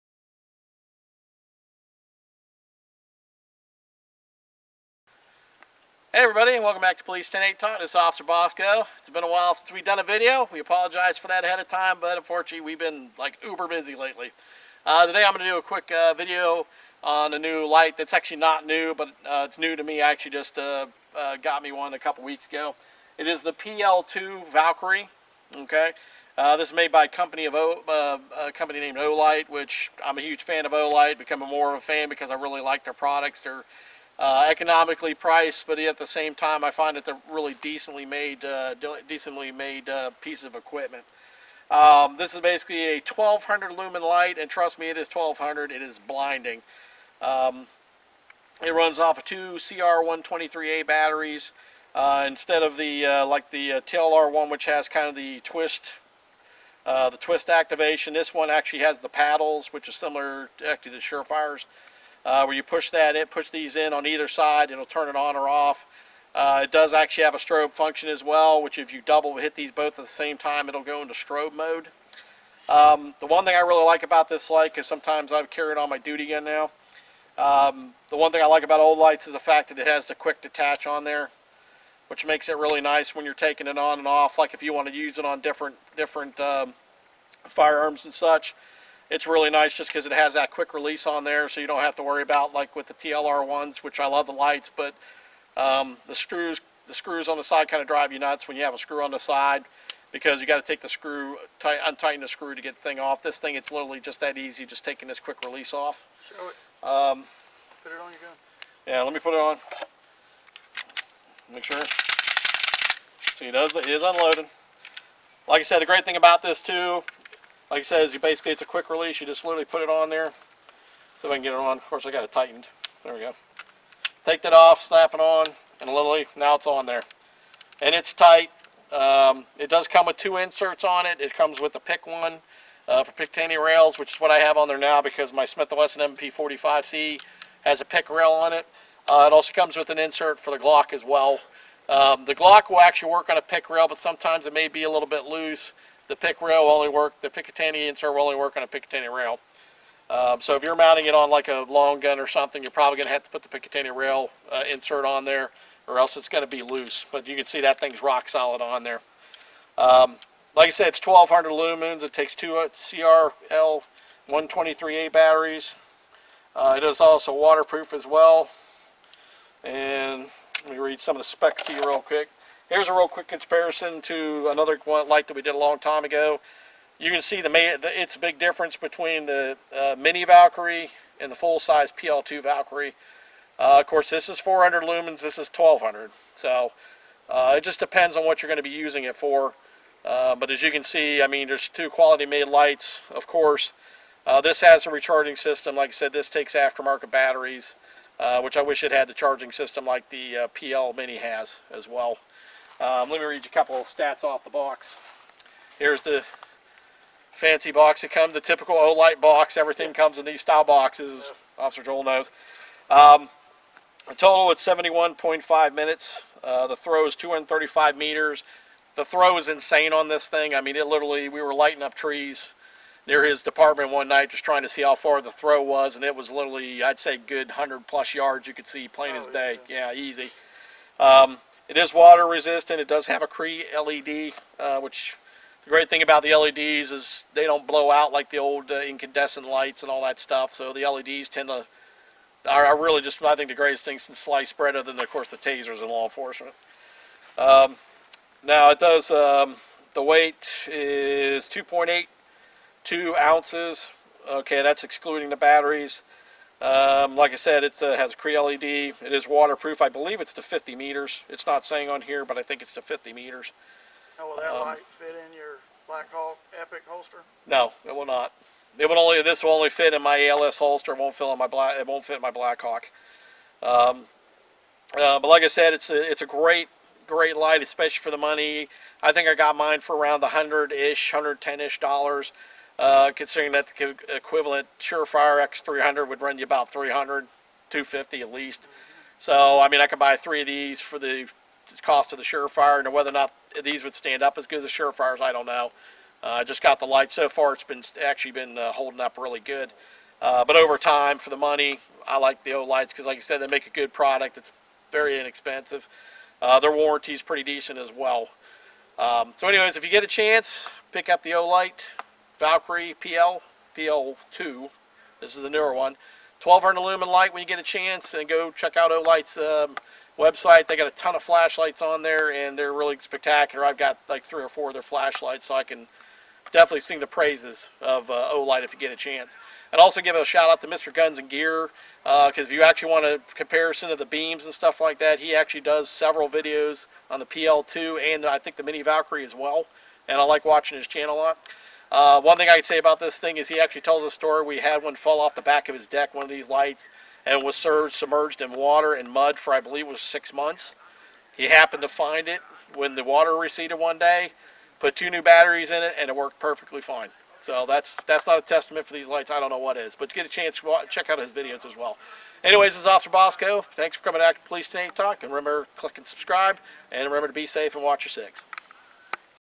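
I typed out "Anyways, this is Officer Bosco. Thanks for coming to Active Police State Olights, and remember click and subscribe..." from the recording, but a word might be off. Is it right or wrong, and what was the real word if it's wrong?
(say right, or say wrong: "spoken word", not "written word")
wrong: "Talk", not "Olights".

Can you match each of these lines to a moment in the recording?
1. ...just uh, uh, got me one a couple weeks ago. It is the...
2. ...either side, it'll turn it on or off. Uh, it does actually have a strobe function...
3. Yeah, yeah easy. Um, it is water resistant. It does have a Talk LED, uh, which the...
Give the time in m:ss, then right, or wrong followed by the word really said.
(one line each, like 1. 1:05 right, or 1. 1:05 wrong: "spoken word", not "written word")
1. 0:20 right
2. 1:04 right
3. 3:49 wrong: "Cree", not "Talk".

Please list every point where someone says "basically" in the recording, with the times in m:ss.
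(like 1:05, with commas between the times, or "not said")
0:42, 1:58.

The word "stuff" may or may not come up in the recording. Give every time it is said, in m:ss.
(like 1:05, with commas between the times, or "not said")
4:00, 5:34.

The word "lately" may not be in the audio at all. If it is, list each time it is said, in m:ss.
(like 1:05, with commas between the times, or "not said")
0:13.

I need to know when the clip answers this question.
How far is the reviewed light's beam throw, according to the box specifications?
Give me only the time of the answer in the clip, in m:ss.
3:37.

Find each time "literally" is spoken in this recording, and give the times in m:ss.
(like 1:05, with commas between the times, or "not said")
1:43, 1:59, 2:05, 3:40, 3:46.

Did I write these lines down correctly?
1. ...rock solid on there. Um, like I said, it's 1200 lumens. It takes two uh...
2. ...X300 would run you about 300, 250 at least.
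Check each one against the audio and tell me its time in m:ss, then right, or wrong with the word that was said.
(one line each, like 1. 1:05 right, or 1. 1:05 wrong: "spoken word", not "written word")
1. 2:38 right
2. 4:45 right.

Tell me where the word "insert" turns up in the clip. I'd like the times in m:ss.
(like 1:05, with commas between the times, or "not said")
2:10, 2:19, 2:27, 2:34.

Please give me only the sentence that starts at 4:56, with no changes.
Uh, I uh, just got the light so far; it's been actually been uh, holding up really good.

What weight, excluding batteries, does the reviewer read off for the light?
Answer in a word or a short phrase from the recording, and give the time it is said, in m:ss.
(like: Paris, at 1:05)
2.82 ounces, at 4:11.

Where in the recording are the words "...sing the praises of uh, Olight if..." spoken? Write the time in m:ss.
5:26.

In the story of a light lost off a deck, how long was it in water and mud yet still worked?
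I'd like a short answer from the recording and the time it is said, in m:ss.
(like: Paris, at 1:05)
6 months, at 5:49.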